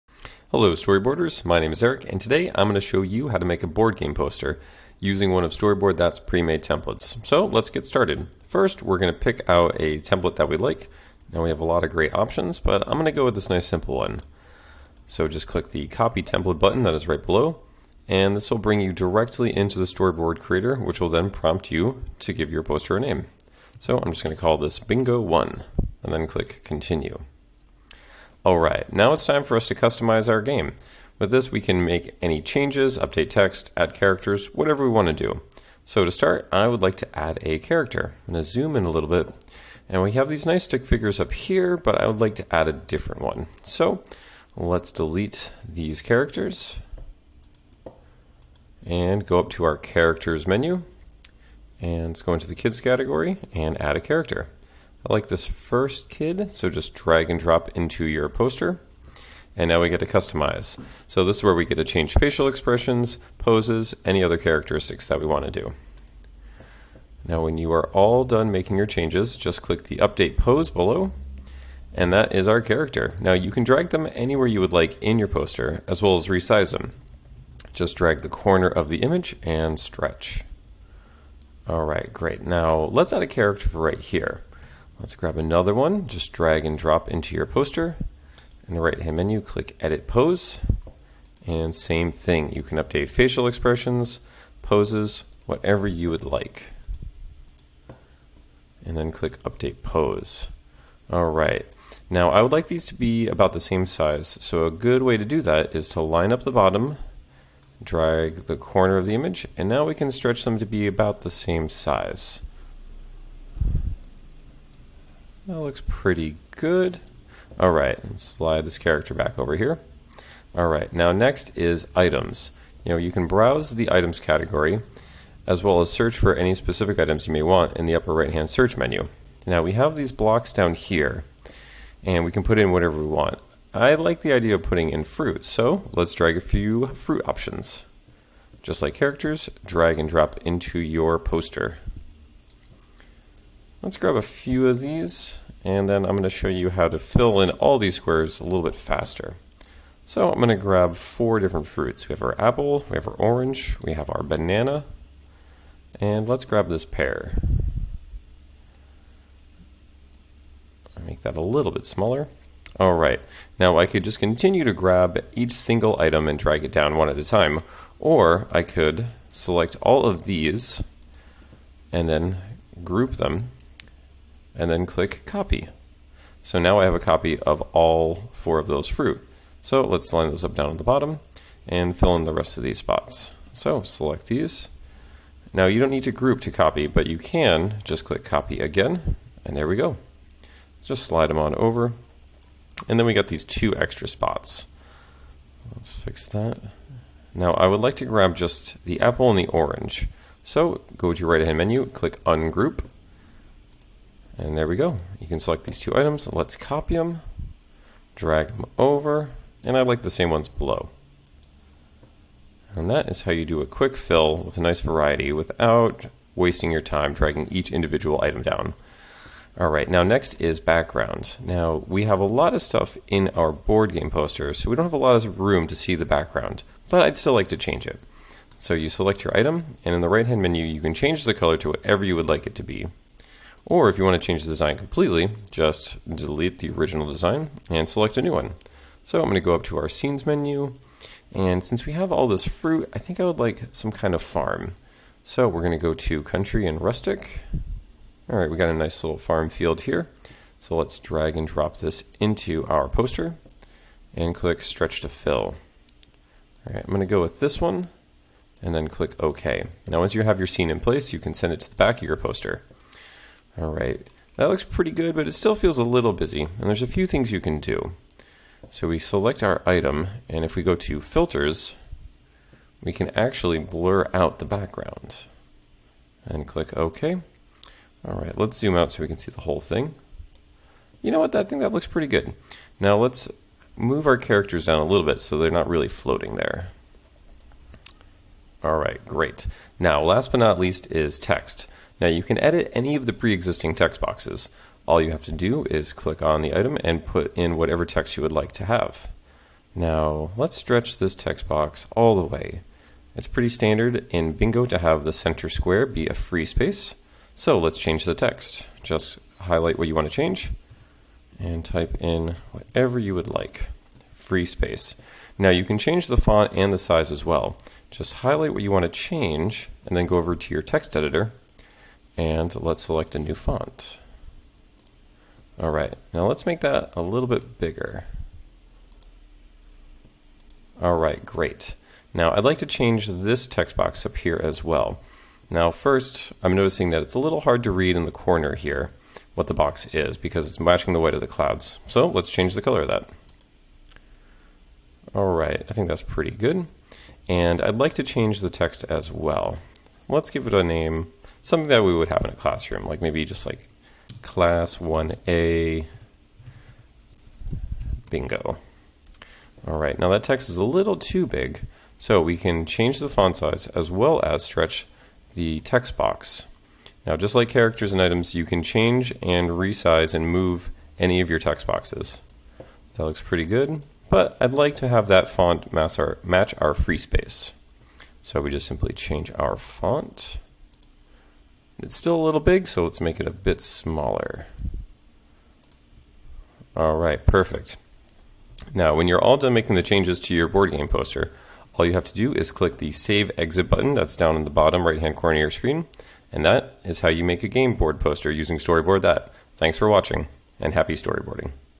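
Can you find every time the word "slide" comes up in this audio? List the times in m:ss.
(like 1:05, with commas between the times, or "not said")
1:58, 3:11.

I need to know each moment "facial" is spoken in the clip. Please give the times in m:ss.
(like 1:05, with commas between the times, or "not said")
1:02, 1:33.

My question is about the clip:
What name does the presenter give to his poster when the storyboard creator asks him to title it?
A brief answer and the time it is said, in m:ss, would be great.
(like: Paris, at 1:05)
bingo 1, at 0:24.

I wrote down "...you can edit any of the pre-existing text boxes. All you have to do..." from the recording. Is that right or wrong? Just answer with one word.
right.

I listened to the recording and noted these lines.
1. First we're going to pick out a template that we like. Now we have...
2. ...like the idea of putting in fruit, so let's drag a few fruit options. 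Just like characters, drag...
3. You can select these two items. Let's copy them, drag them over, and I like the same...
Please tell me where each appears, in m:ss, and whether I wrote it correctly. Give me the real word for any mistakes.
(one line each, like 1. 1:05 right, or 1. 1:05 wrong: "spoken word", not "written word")
1. 0:08 right
2. 2:13 right
3. 3:25 right.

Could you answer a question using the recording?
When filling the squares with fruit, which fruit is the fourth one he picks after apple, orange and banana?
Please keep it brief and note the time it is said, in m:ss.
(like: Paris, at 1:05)
pear, at 2:36.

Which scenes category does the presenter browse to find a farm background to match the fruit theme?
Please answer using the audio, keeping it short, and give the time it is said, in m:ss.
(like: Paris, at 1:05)
country and rustic, at 4:06.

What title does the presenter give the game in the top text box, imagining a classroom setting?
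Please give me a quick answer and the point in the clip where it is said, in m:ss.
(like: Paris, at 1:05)
class 1A bingo, at 5:54.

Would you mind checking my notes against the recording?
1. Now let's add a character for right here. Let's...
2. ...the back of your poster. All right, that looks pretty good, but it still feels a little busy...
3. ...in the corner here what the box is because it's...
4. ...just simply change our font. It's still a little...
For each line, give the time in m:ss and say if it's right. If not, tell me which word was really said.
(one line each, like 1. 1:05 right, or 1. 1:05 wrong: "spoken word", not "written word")
1. 1:22 right
2. 4:21 right
3. 5:37 right
4. 6:18 right.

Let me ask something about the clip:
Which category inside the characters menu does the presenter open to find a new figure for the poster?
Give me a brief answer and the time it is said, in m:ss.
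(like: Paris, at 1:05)
kids, at 0:52.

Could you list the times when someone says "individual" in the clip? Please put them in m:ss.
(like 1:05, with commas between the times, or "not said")
3:37.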